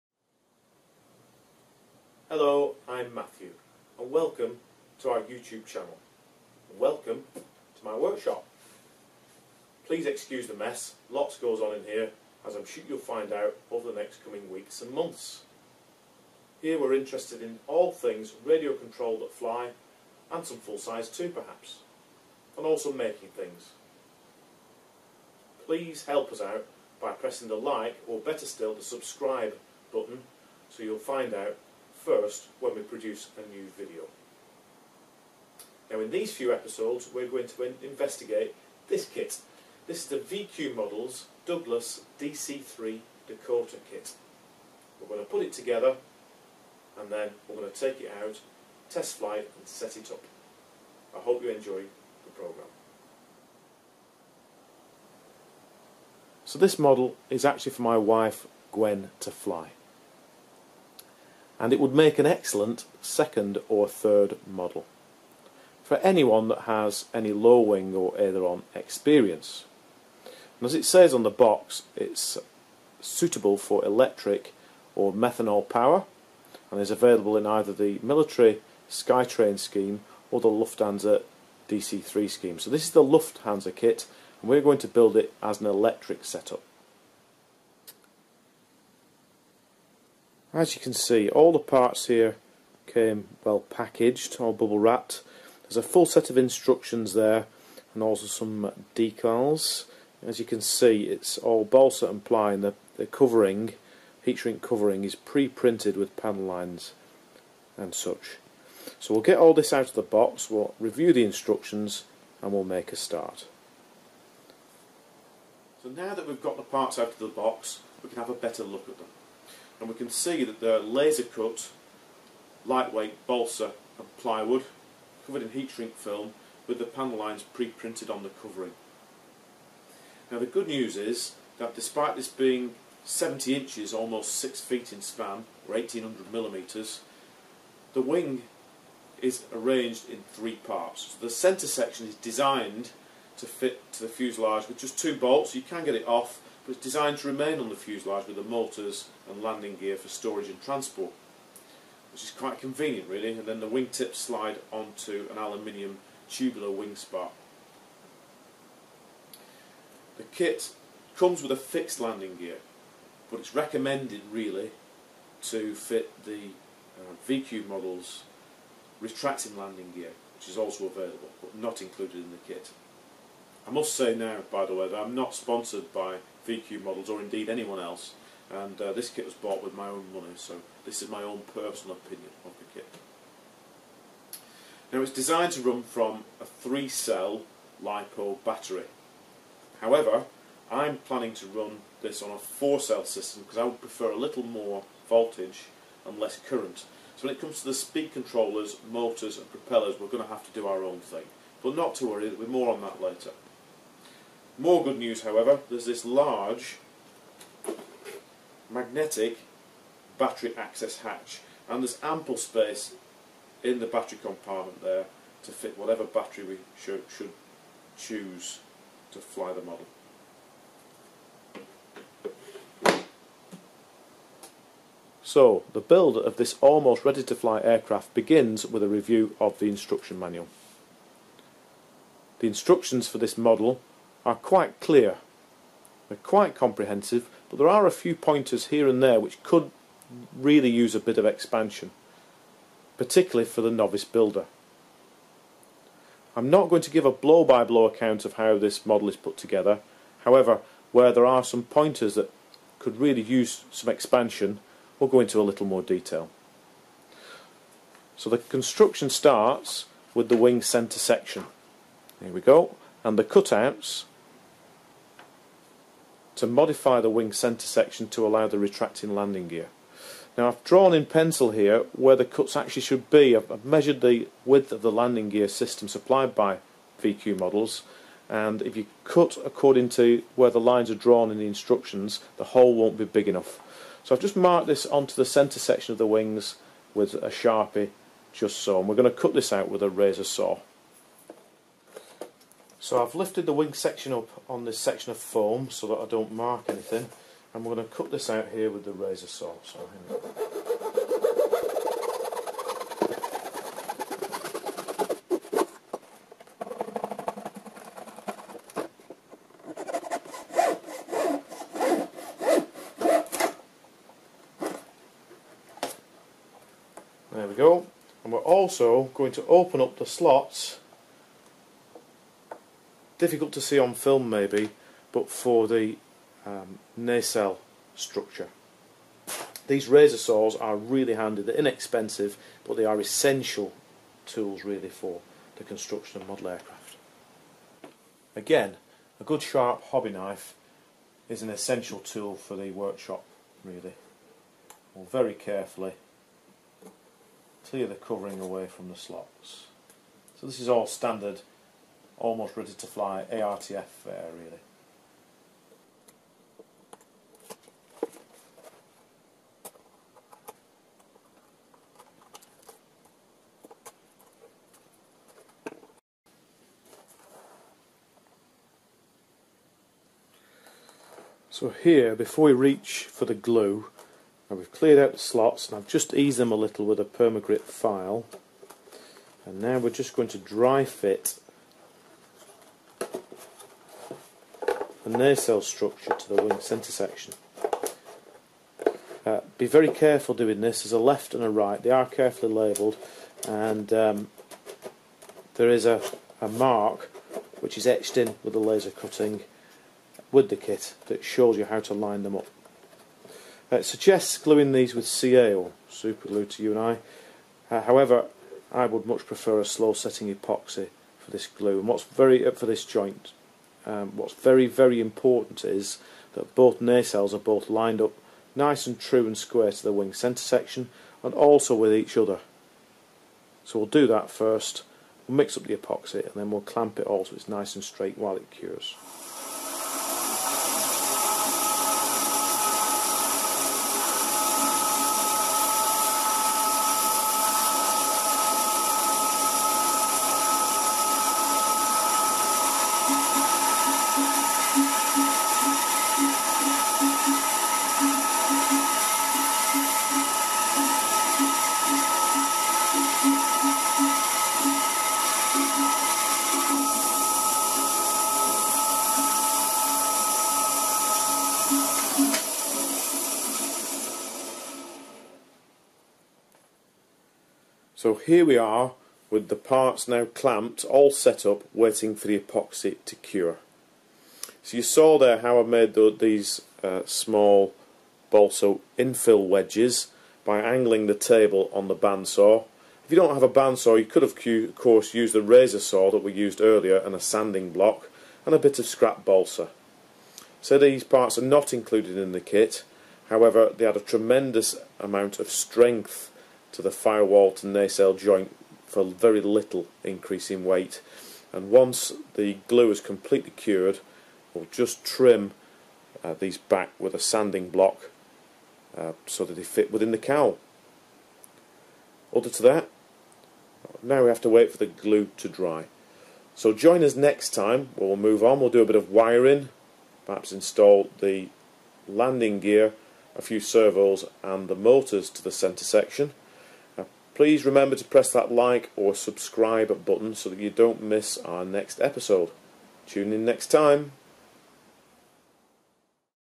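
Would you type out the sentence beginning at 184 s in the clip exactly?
Now it's designed to run from a 3-cell LiPo battery.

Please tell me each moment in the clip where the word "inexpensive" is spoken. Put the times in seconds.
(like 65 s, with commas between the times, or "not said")
331 s.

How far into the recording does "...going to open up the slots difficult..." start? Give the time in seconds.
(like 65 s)
319 s.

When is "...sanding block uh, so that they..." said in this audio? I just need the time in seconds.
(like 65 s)
507 s.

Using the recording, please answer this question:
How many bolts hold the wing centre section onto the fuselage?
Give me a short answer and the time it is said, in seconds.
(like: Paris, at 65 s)
2, at 144 s.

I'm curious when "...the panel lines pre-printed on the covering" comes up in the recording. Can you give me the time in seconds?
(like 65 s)
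126 s.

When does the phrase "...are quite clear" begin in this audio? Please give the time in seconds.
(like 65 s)
234 s.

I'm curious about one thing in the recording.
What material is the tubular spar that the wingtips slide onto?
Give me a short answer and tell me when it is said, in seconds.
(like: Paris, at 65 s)
Aluminium, at 155 s.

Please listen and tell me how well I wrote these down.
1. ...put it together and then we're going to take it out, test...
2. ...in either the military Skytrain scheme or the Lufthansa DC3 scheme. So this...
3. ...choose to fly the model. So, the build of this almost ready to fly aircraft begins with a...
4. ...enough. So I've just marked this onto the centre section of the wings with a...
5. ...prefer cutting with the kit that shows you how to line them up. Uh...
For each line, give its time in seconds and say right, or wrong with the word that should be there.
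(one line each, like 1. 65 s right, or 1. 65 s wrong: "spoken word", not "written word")
1. 45 s right
2. 77 s right
3. 217 s right
4. 283 s right
5. 398 s wrong: "laser", not "prefer".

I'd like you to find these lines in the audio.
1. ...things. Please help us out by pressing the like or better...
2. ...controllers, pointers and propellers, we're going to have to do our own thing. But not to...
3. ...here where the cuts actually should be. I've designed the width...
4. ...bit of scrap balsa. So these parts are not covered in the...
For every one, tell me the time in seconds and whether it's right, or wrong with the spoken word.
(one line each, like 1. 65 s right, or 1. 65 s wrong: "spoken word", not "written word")
1. 23 s right
2. 198 s wrong: "motors", not "pointers"
3. 271 s wrong: "measured", not "designed"
4. 488 s wrong: "included", not "covered".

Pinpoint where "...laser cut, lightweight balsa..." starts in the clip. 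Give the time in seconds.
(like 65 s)
120 s.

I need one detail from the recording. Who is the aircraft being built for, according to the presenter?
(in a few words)
Gwen.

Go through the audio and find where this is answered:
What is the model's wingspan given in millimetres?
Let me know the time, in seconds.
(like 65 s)
135 s.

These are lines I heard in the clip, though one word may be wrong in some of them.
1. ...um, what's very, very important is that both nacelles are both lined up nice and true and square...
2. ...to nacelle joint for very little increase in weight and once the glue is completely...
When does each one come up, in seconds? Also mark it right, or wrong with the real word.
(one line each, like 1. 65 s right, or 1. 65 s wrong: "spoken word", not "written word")
1. 413 s right
2. 497 s right.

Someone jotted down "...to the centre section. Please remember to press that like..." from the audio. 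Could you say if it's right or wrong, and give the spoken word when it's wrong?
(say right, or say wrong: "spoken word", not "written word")
right.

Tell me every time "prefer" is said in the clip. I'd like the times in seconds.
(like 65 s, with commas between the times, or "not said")
193 s, 409 s.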